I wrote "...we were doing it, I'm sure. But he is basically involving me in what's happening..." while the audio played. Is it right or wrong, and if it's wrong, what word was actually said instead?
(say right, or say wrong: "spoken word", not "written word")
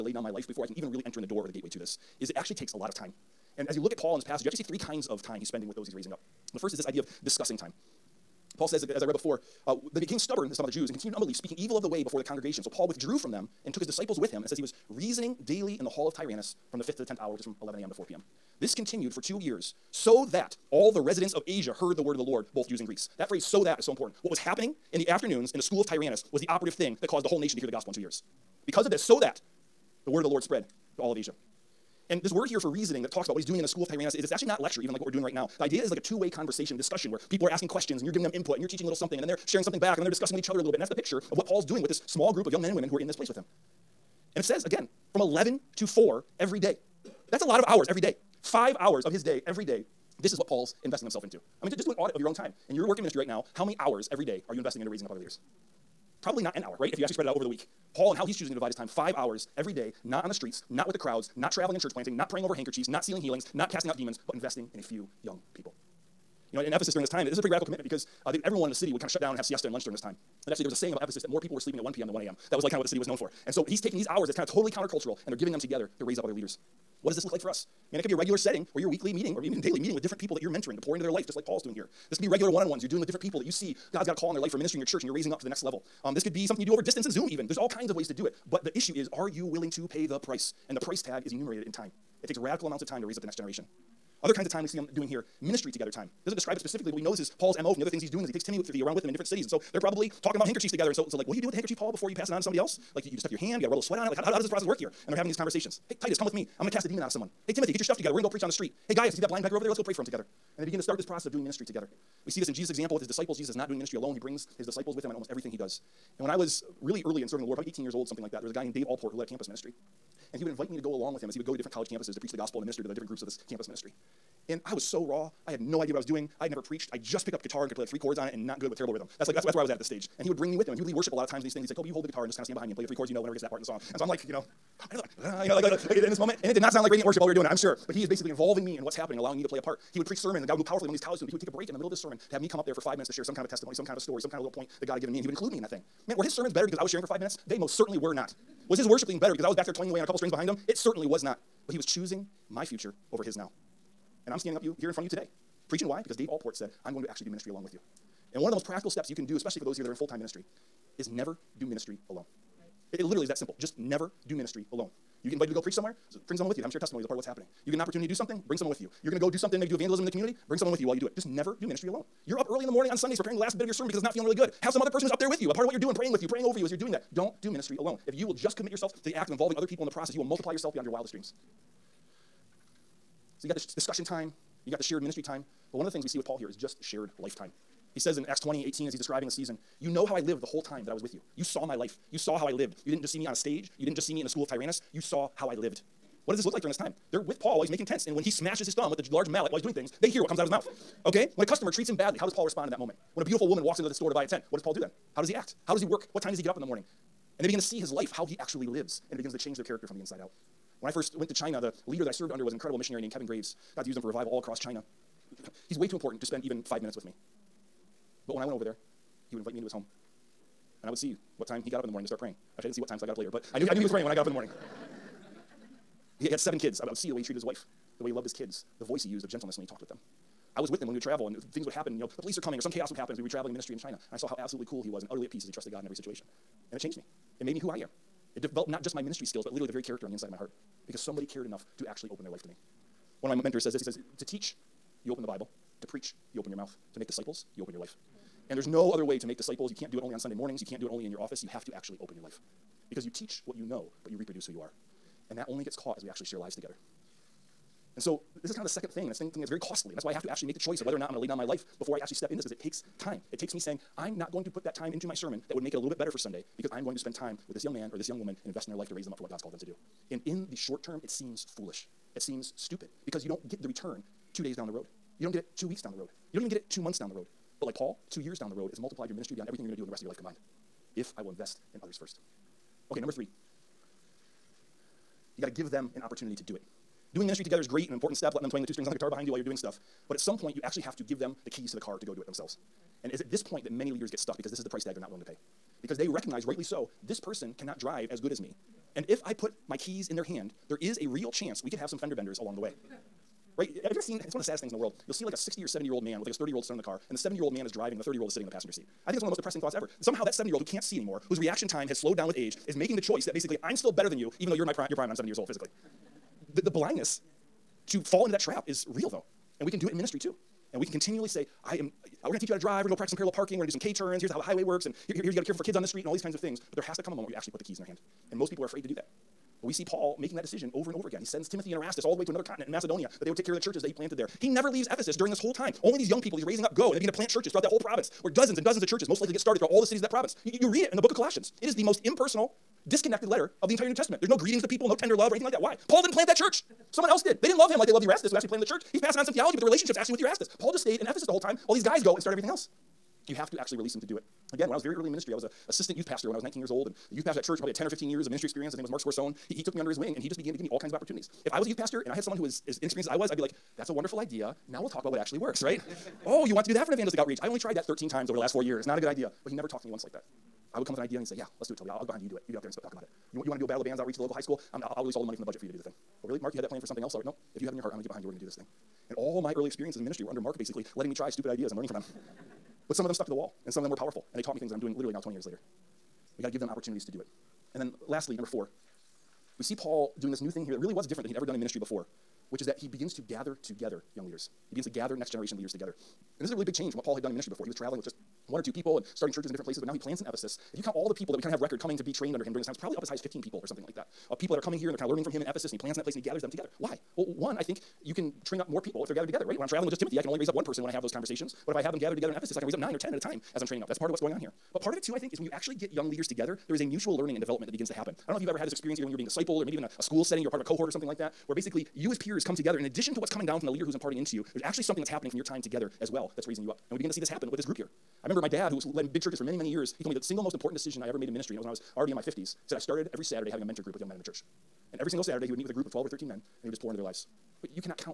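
right.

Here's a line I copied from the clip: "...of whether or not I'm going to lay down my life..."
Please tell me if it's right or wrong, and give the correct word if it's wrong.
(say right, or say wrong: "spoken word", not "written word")
right.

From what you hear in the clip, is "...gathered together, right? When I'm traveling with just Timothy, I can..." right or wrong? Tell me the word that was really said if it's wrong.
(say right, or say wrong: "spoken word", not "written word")
right.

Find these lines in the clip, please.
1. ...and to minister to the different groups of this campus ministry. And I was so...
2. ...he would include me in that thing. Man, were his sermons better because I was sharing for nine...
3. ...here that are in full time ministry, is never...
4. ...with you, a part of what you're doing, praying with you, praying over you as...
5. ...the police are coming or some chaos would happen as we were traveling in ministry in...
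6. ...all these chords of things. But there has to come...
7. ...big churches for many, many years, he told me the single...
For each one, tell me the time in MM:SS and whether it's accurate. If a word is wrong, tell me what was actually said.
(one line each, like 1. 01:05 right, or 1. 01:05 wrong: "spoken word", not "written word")
1. 02:02 right
2. 02:25 wrong: "five", not "nine"
3. 02:39 right
4. 02:55 right
5. 03:52 right
6. 05:26 wrong: "kinds", not "chords"
7. 07:09 right.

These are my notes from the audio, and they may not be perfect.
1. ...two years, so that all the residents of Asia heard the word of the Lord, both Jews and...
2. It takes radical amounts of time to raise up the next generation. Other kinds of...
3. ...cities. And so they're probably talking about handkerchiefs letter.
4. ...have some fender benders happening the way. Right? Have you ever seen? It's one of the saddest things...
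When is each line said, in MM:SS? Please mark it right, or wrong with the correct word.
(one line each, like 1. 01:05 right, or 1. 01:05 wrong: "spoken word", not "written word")
1. 00:19 right
2. 01:32 right
3. 01:39 wrong: "together", not "letter"
4. 05:01 wrong: "along", not "happening".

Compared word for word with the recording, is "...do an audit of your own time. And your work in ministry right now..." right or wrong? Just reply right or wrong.
right.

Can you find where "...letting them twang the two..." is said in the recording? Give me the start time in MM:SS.
04:48.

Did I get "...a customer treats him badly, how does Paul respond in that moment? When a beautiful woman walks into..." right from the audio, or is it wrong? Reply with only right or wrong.
right.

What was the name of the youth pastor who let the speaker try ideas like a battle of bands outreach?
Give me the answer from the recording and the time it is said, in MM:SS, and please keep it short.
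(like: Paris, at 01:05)
Mark Scorsone, at 05:58.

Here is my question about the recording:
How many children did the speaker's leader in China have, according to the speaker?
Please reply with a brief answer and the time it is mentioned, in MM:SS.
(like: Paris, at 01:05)
7, at 03:46.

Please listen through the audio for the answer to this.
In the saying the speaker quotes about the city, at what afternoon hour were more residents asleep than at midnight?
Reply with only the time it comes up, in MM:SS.
01:11.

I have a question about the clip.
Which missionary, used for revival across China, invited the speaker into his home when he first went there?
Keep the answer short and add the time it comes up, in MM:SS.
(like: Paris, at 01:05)
Kevin Graves, at 03:33.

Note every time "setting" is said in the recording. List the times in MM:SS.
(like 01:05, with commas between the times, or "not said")
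01:18, 07:00.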